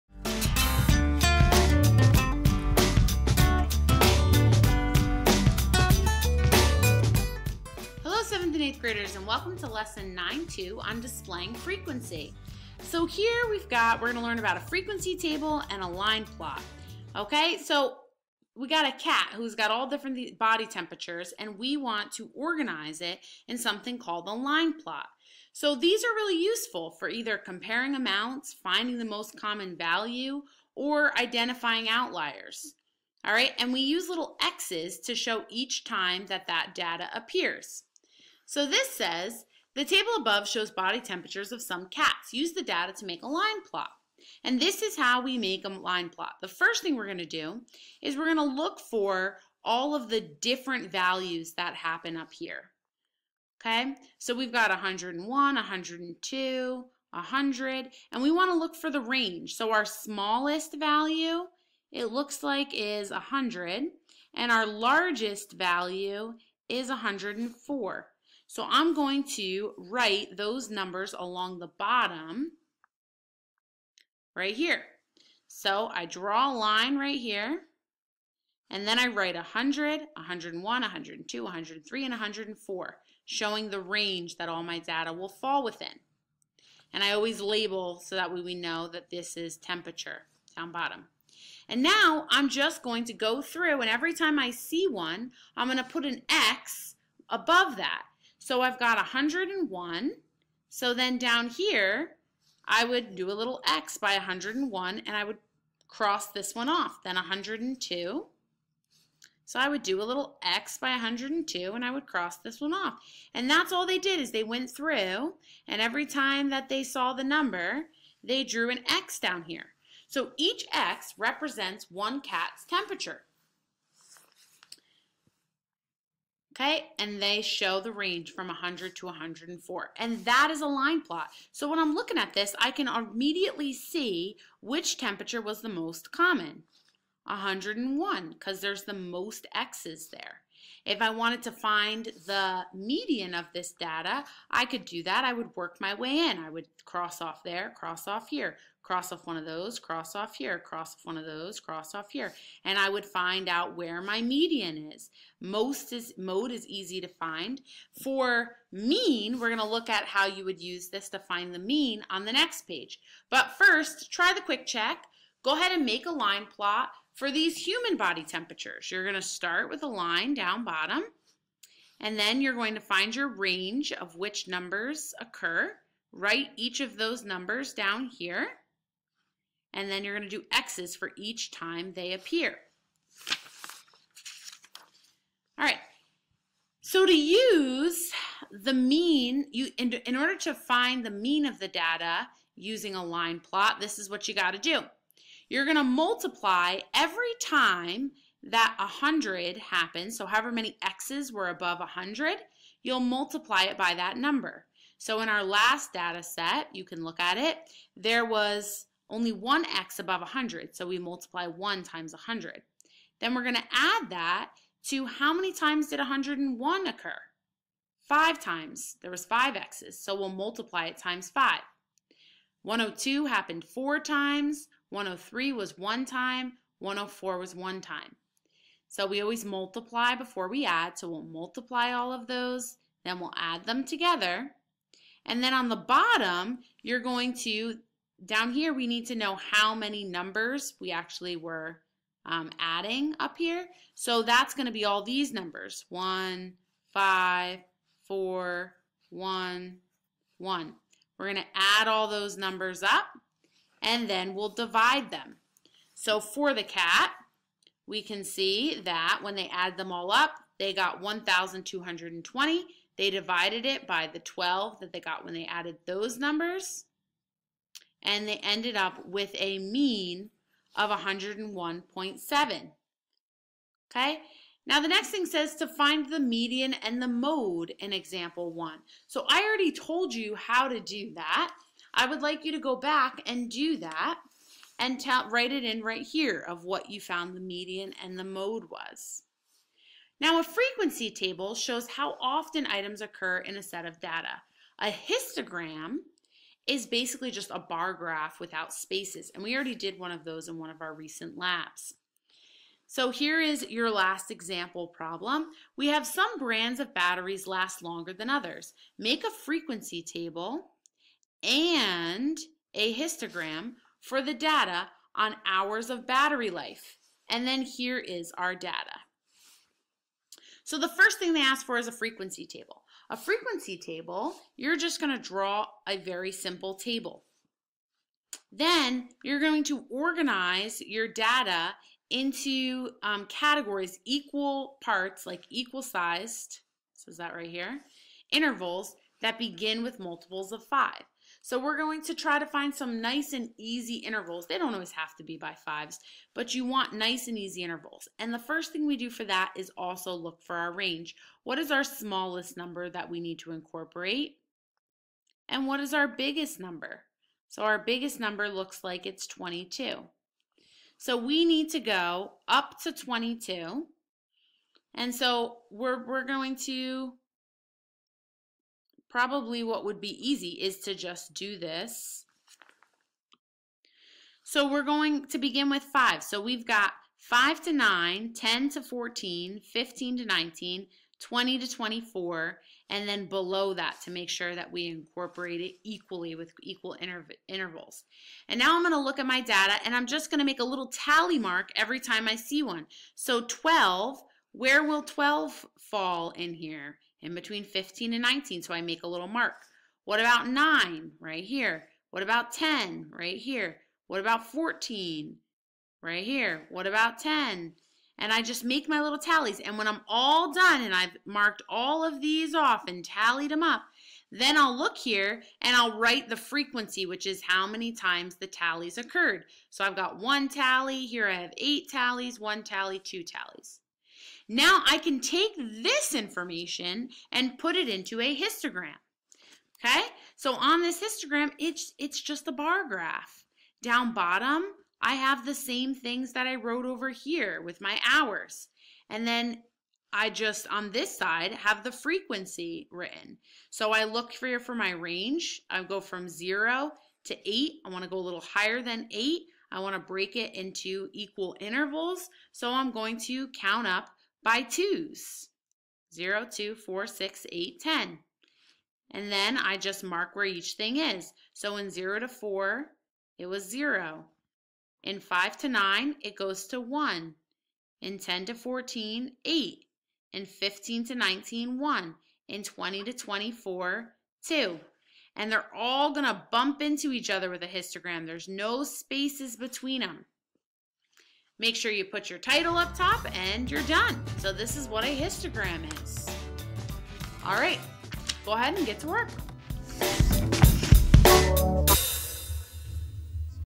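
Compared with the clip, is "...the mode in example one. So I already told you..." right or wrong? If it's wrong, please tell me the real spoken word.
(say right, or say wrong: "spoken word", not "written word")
right.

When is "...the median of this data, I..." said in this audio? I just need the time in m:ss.
2:22.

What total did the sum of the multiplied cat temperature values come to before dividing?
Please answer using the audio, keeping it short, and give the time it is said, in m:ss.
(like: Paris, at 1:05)
1,220, at 4:21.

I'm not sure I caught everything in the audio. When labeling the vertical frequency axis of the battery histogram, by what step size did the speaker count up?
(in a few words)
2.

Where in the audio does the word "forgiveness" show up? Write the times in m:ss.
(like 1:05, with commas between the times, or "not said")
not said.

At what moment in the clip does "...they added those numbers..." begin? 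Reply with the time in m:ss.
4:25.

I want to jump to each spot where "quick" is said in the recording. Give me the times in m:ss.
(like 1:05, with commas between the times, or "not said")
2:44.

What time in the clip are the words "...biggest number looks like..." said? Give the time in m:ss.
5:57.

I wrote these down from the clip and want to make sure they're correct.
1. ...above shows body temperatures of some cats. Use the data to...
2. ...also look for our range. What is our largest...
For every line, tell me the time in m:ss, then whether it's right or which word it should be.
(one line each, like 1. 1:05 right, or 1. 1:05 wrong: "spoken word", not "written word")
1. 0:40 right
2. 5:49 wrong: "smallest", not "largest".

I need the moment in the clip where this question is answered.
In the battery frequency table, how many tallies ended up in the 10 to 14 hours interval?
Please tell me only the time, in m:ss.
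7:01.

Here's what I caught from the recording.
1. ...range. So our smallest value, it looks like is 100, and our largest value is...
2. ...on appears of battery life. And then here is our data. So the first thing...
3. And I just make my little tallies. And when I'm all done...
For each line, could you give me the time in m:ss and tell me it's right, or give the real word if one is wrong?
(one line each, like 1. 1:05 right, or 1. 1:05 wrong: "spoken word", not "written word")
1. 0:58 right
2. 5:15 wrong: "hours", not "appears"
3. 6:48 right.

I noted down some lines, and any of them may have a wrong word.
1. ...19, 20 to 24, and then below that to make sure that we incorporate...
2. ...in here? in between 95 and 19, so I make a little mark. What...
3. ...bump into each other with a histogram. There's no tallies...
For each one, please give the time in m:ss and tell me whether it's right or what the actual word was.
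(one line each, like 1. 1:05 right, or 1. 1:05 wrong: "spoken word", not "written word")
1. 6:20 right
2. 6:36 wrong: "15", not "95"
3. 7:56 wrong: "spaces", not "tallies".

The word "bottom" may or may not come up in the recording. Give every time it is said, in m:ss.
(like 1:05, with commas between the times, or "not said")
1:11, 1:30, 2:50, 3:55, 7:14.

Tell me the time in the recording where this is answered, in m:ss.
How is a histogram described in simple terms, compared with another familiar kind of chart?
4:57.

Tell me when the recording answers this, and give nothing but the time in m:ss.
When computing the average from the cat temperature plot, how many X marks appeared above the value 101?
3:38.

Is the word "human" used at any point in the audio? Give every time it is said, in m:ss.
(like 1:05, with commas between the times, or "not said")
2:47.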